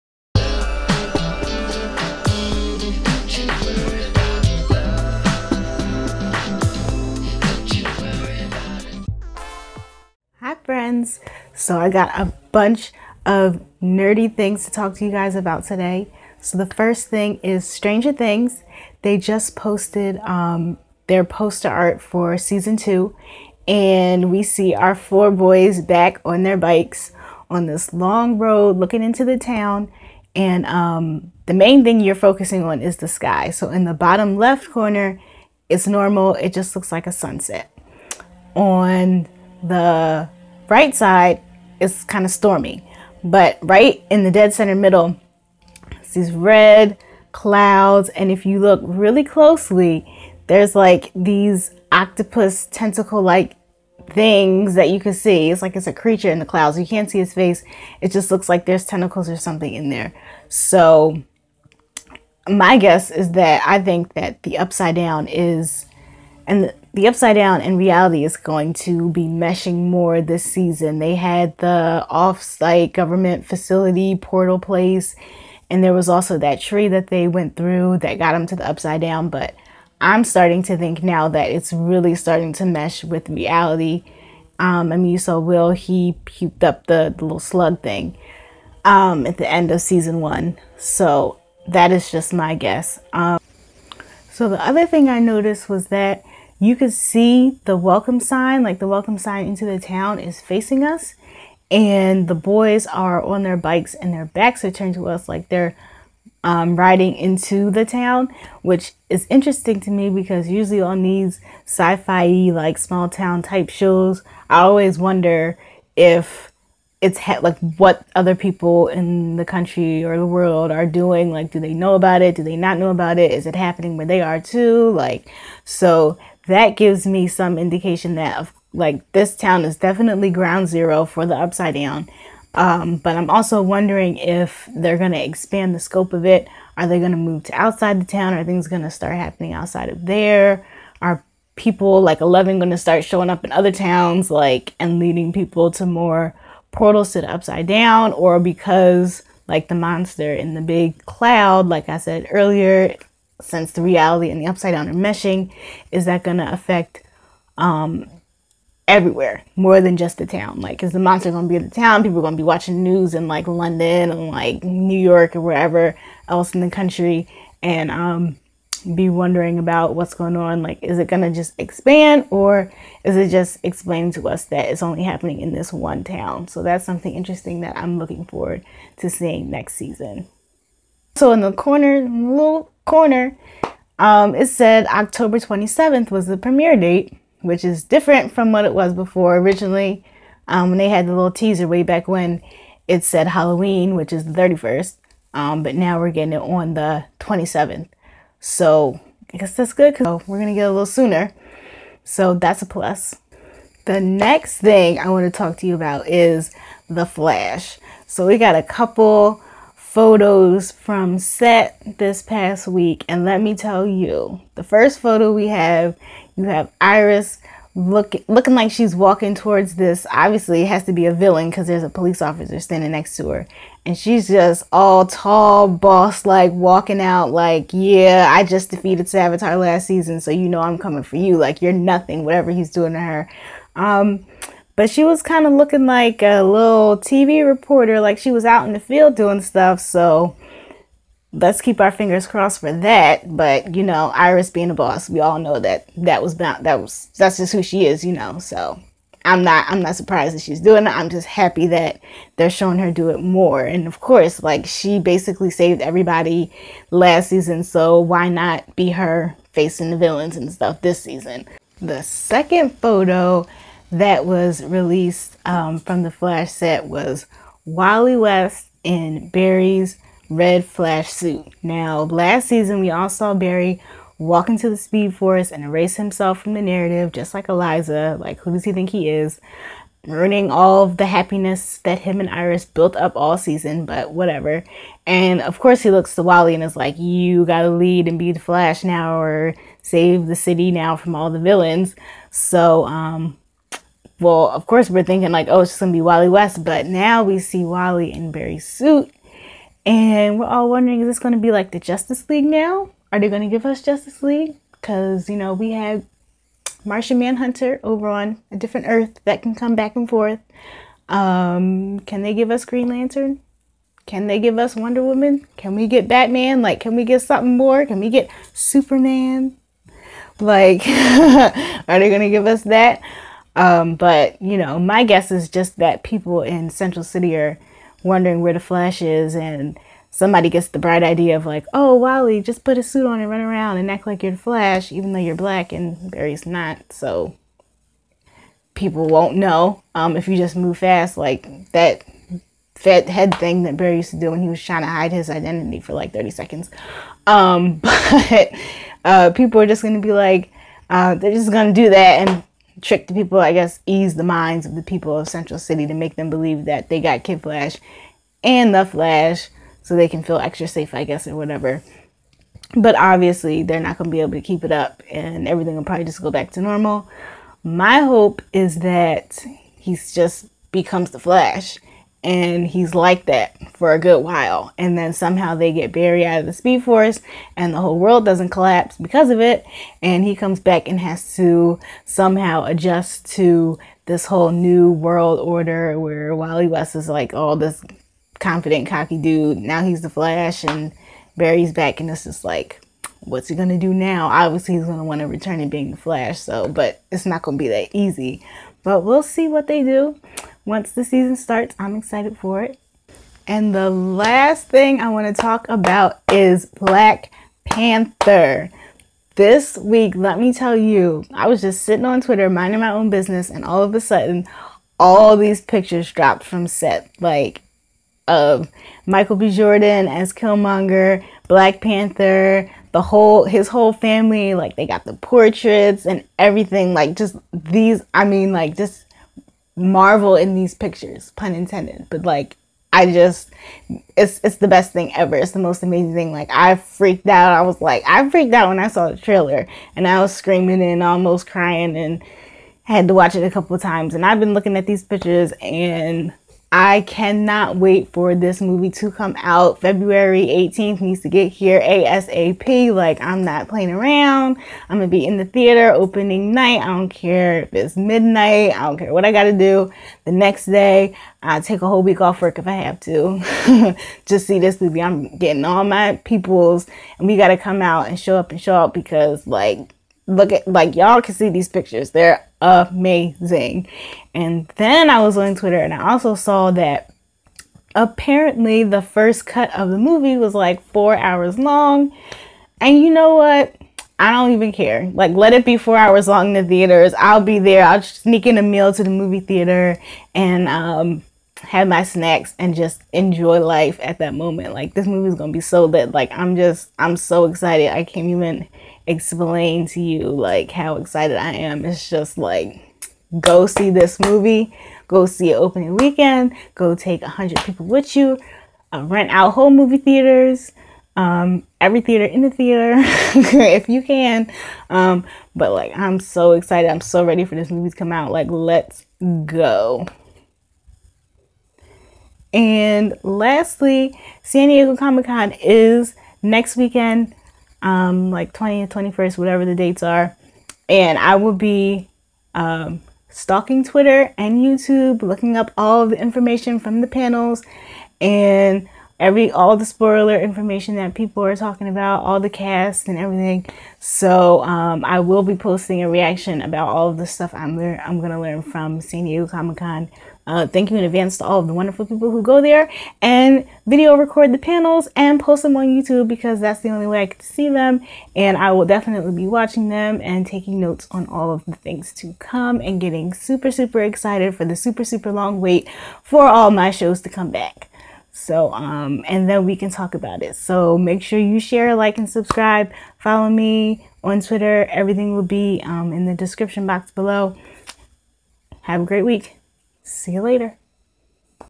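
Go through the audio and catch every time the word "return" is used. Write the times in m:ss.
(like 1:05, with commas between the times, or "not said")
6:35.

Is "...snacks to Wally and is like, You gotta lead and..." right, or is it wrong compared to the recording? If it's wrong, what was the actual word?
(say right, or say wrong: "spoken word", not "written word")
wrong: "looks", not "snacks".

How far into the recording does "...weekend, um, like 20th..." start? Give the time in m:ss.
8:46.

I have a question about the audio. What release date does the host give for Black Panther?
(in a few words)
February 18th.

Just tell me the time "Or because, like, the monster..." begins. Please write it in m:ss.
2:28.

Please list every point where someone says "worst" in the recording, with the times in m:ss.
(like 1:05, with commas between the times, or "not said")
not said.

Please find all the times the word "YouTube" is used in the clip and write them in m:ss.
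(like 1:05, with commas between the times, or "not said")
8:54, 9:15.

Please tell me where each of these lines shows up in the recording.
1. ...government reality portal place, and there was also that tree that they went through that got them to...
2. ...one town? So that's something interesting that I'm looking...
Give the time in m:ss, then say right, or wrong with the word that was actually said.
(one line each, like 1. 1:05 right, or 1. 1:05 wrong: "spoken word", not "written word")
1. 1:12 wrong: "facility", not "reality"
2. 2:55 right.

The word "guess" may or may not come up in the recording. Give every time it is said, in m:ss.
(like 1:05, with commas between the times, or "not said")
1:02, 1:32, 3:19, 5:25, 5:53, 6:01.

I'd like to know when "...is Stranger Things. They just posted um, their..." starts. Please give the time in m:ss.
0:17.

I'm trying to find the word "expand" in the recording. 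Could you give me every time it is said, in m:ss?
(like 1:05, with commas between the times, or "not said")
2:15, 2:51.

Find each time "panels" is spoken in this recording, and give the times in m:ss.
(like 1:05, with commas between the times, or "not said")
8:57, 9:14.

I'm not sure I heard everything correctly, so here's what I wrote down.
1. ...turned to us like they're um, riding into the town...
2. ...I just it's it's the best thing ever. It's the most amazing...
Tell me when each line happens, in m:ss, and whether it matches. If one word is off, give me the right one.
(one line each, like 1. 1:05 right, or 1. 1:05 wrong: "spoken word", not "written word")
1. 1:44 right
2. 7:12 right.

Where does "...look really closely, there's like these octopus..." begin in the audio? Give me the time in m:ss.
0:48.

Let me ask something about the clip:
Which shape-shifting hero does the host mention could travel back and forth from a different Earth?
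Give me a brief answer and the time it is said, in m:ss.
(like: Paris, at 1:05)
Martian Manhunter, at 5:06.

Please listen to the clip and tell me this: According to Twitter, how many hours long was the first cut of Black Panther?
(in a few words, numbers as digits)
4 hours.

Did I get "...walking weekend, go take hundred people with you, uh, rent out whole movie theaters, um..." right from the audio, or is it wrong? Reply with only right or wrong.
wrong.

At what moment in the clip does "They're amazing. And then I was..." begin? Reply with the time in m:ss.
7:52.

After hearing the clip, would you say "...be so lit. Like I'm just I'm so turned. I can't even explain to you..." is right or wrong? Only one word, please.
wrong.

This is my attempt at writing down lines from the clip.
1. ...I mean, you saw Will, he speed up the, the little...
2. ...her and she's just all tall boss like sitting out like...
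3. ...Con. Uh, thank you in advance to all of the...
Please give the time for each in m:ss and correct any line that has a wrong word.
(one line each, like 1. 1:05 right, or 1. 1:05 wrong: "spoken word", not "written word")
1. 1:24 wrong: "puked", not "speed"
2. 3:43 wrong: "walking", not "sitting"
3. 9:09 right.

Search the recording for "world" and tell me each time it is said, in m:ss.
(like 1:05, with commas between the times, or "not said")
2:00, 6:17, 6:24.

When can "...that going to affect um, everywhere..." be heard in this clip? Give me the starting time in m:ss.
2:36.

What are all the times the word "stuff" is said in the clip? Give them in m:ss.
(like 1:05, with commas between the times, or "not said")
3:59, 4:20, 9:07.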